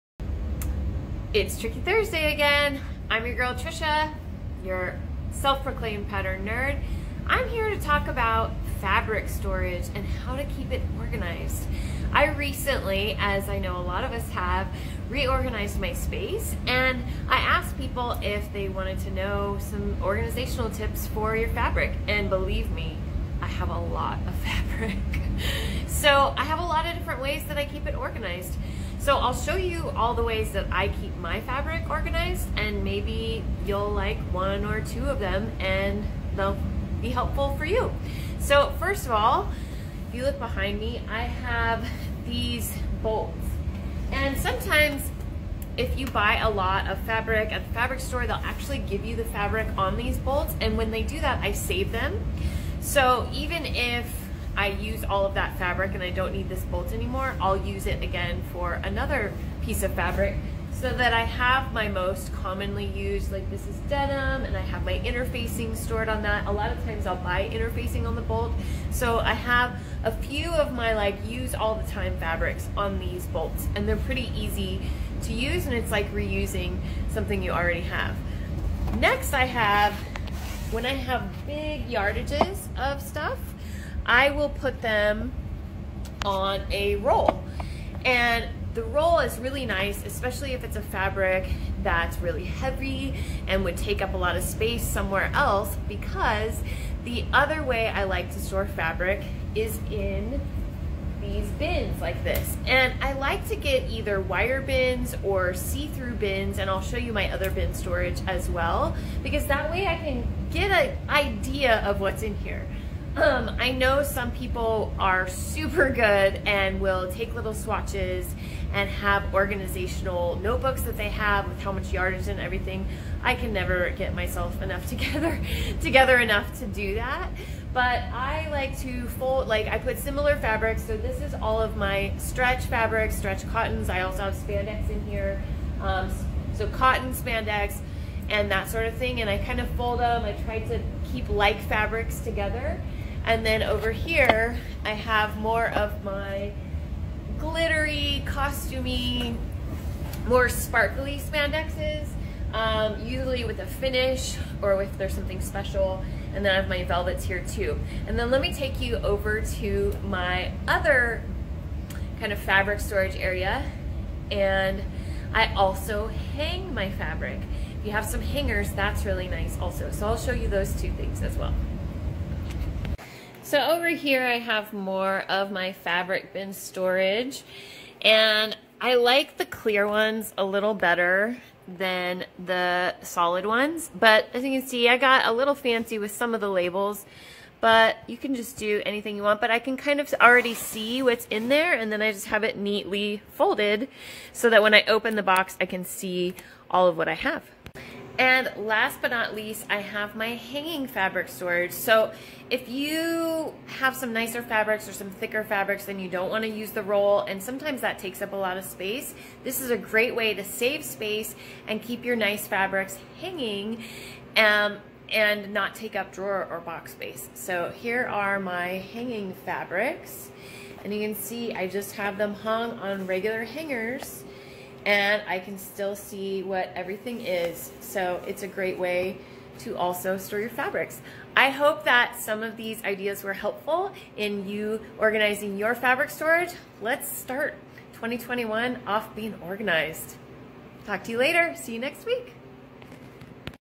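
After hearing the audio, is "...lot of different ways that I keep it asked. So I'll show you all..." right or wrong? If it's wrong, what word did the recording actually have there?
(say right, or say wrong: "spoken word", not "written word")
wrong: "organized", not "asked".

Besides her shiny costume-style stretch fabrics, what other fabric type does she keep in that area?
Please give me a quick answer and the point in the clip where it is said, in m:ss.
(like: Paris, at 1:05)
velvets, at 2:36.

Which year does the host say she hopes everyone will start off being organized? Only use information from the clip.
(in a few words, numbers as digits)
2021.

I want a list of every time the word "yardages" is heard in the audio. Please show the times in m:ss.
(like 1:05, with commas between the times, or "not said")
1:21, 2:01.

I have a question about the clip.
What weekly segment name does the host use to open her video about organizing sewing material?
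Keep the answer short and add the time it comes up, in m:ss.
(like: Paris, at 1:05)
Tricky Thursday, at 0:01.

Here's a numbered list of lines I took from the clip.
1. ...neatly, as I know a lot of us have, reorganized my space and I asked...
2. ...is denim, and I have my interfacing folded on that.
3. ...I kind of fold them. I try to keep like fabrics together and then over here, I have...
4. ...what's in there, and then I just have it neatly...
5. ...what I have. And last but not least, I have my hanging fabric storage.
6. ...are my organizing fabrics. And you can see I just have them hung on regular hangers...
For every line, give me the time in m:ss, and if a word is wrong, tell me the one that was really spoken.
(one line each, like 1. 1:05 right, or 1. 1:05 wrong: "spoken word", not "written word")
1. 0:12 wrong: "recently", not "neatly"
2. 1:03 wrong: "stored", not "folded"
3. 2:19 right
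4. 3:11 right
5. 3:16 right
6. 3:38 wrong: "hanging", not "organizing".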